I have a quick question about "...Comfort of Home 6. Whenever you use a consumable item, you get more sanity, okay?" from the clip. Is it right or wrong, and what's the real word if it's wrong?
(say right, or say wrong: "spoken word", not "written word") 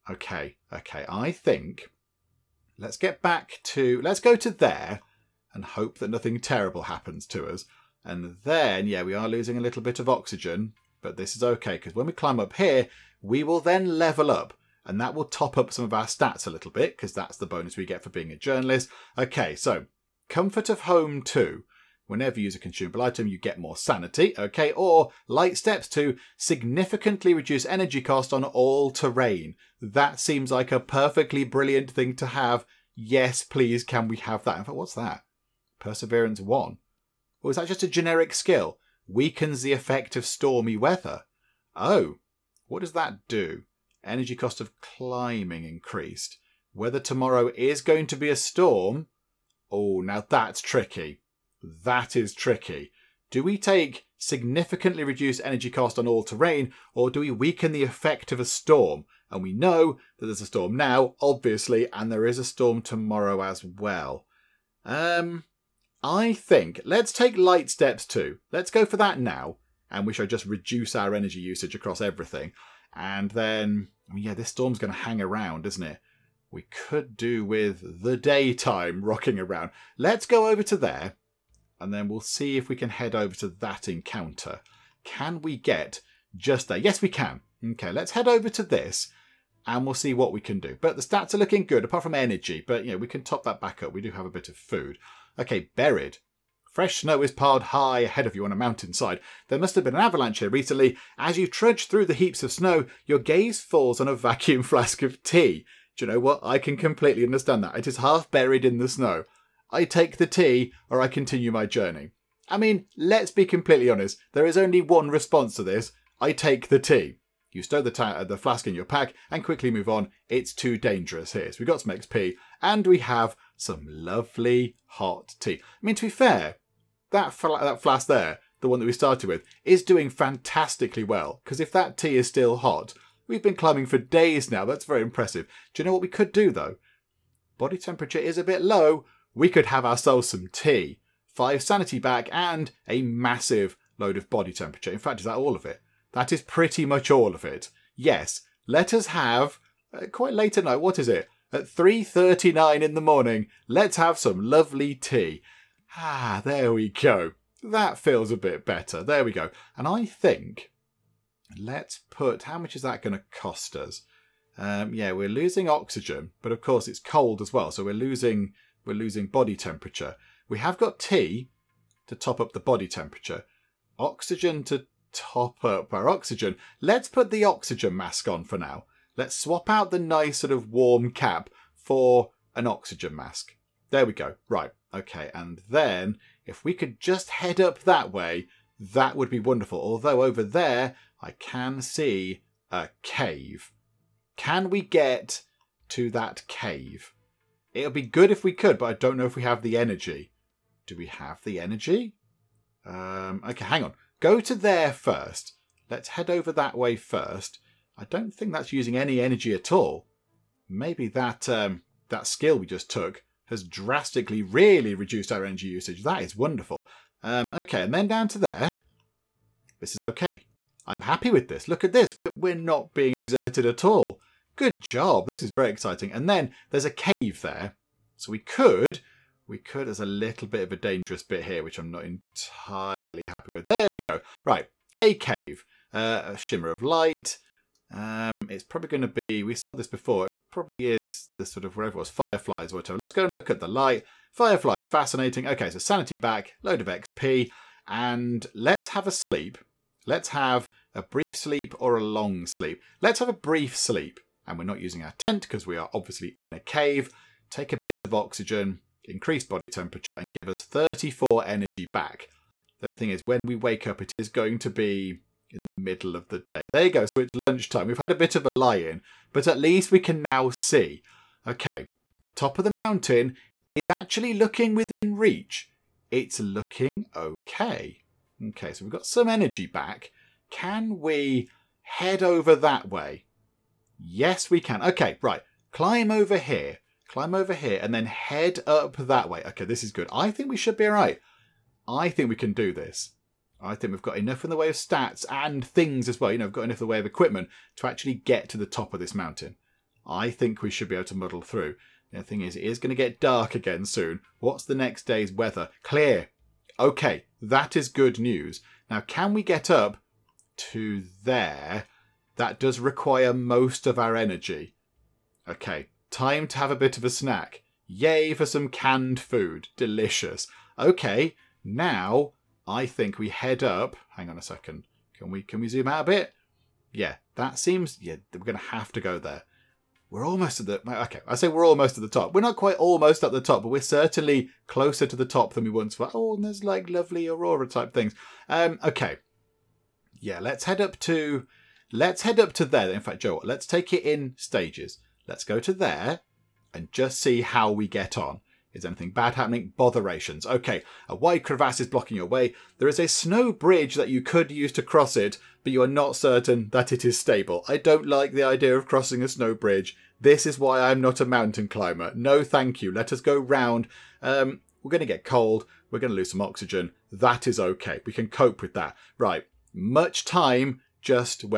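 wrong: "2", not "6".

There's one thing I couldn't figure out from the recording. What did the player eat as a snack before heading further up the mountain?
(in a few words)
Canned food.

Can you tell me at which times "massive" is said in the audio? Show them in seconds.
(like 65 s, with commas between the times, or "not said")
143 s.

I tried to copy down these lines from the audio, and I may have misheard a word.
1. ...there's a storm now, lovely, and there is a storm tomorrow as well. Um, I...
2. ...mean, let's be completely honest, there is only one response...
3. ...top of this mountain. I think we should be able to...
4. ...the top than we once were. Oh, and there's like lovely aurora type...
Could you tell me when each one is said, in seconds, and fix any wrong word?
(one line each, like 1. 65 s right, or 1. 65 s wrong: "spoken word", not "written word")
1. 60 s wrong: "obviously", not "lovely"
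2. 112 s right
3. 298 s right
4. 335 s right.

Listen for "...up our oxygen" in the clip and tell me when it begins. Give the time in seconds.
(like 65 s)
175 s.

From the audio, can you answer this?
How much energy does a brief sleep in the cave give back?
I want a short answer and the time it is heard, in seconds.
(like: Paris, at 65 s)
34, at 260 s.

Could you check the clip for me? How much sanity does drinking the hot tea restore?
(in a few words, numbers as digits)
5.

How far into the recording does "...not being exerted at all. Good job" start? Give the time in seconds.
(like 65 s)
222 s.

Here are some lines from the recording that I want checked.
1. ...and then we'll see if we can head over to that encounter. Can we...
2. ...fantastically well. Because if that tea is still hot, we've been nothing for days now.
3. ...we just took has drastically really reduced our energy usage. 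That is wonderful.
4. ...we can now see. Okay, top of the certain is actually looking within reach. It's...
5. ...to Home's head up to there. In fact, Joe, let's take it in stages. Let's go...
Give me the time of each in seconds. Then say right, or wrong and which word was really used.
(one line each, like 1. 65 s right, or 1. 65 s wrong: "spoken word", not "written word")
1. 81 s right
2. 130 s wrong: "climbing", not "nothing"
3. 212 s right
4. 269 s wrong: "mountain", not "certain"
5. 341 s wrong: "Let", not "Home".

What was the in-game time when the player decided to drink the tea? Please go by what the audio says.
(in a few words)
3.39 in the morning.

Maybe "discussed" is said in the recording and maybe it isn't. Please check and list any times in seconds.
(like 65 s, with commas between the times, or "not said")
not said.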